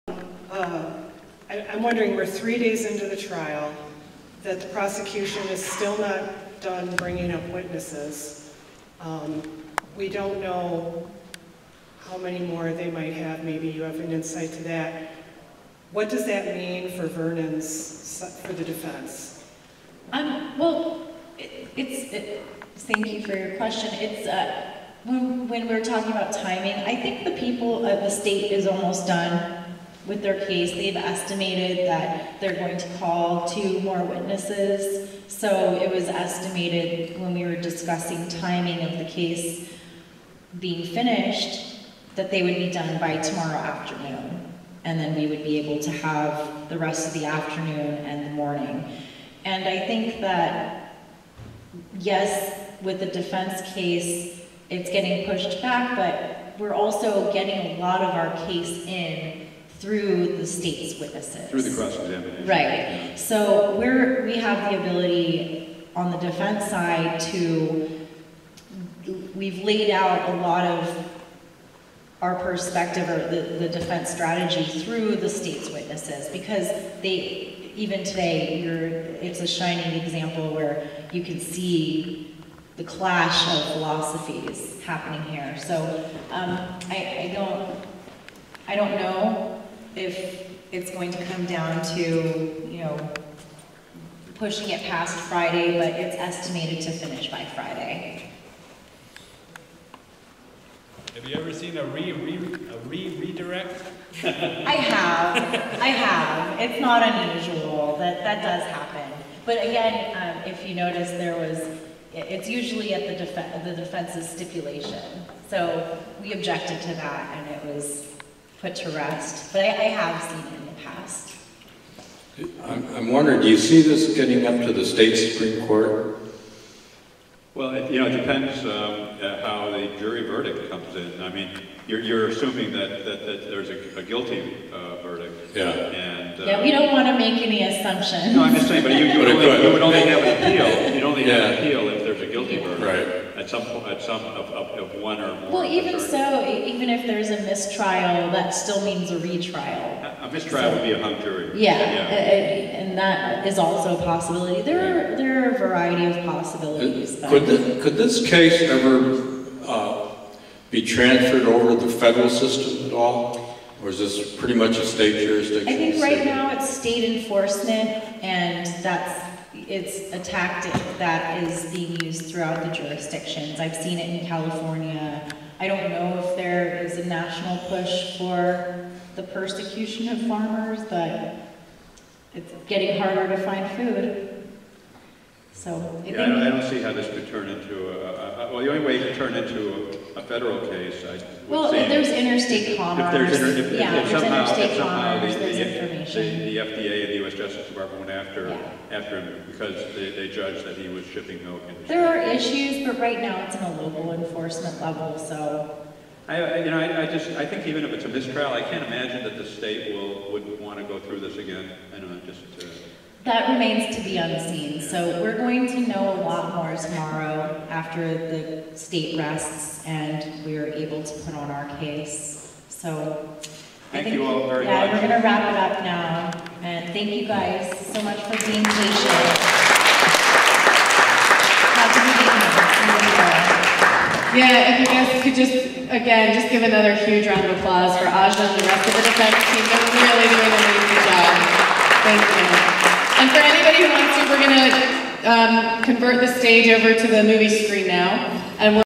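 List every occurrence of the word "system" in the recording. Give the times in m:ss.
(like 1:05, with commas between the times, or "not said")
2:42.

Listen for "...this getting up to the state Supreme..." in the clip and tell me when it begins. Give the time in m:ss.
2:03.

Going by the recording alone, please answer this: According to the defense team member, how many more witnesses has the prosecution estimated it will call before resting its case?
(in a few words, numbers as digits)
2.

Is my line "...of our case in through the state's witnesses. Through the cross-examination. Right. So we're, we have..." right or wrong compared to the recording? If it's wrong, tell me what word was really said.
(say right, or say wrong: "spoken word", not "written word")
right.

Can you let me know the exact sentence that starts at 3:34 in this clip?
So we're going to know a lot more tomorrow after the state rests and we are able to put on our case.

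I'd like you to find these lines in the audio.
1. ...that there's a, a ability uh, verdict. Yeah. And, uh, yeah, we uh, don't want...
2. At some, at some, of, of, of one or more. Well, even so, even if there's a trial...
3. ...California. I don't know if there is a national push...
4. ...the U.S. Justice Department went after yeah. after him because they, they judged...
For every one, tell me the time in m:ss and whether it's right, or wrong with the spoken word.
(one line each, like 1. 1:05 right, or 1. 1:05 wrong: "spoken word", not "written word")
1. 2:13 wrong: "guilty", not "ability"
2. 2:23 wrong: "mistrial", not "trial"
3. 2:54 right
4. 3:17 right.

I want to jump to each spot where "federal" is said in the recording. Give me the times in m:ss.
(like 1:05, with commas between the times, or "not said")
2:41, 3:10.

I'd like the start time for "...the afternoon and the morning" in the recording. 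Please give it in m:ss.
0:47.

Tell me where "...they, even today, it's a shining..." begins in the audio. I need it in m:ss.
1:17.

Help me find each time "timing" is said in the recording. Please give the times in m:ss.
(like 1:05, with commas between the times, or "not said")
0:26, 0:38.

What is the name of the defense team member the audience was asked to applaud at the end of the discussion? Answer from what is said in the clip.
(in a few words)
Aja.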